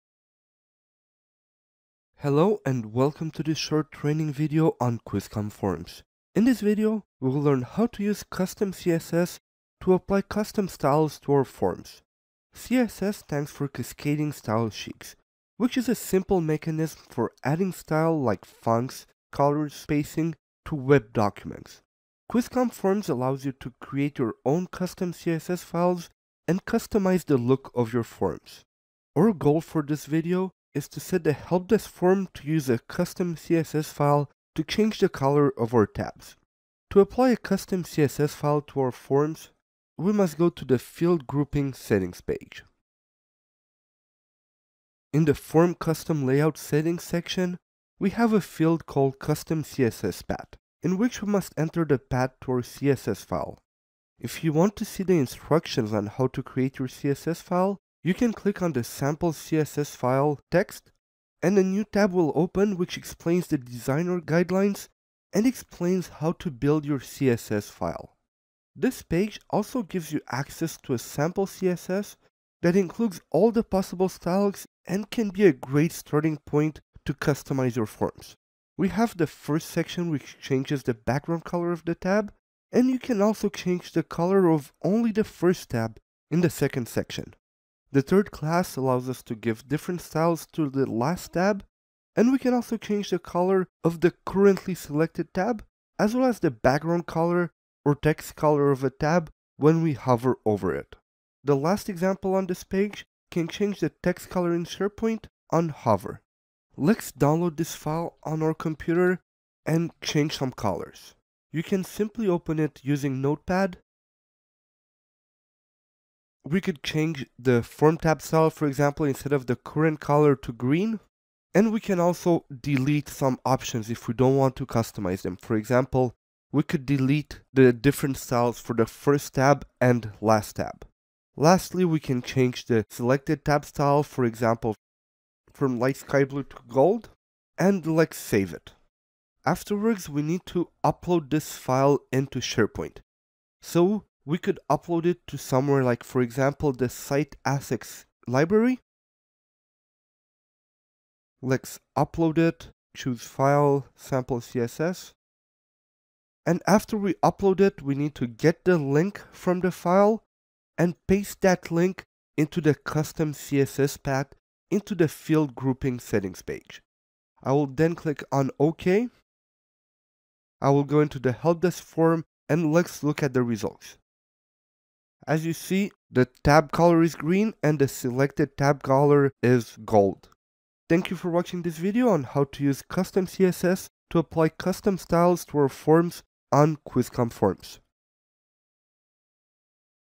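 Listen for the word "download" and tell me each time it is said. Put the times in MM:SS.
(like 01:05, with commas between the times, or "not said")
01:47.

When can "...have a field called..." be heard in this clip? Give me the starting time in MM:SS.
00:48.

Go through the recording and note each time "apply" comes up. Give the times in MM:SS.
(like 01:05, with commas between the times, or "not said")
00:09, 00:36, 03:04.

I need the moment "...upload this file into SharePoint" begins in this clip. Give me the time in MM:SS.
02:20.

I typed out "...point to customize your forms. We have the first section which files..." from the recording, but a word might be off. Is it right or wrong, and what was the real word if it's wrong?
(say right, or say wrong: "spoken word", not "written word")
wrong: "changes", not "files".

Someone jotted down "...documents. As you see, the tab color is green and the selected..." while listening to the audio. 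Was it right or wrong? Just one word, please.
wrong.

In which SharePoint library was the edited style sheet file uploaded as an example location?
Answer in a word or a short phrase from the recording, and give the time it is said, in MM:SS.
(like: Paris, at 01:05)
Site Assets, at 02:26.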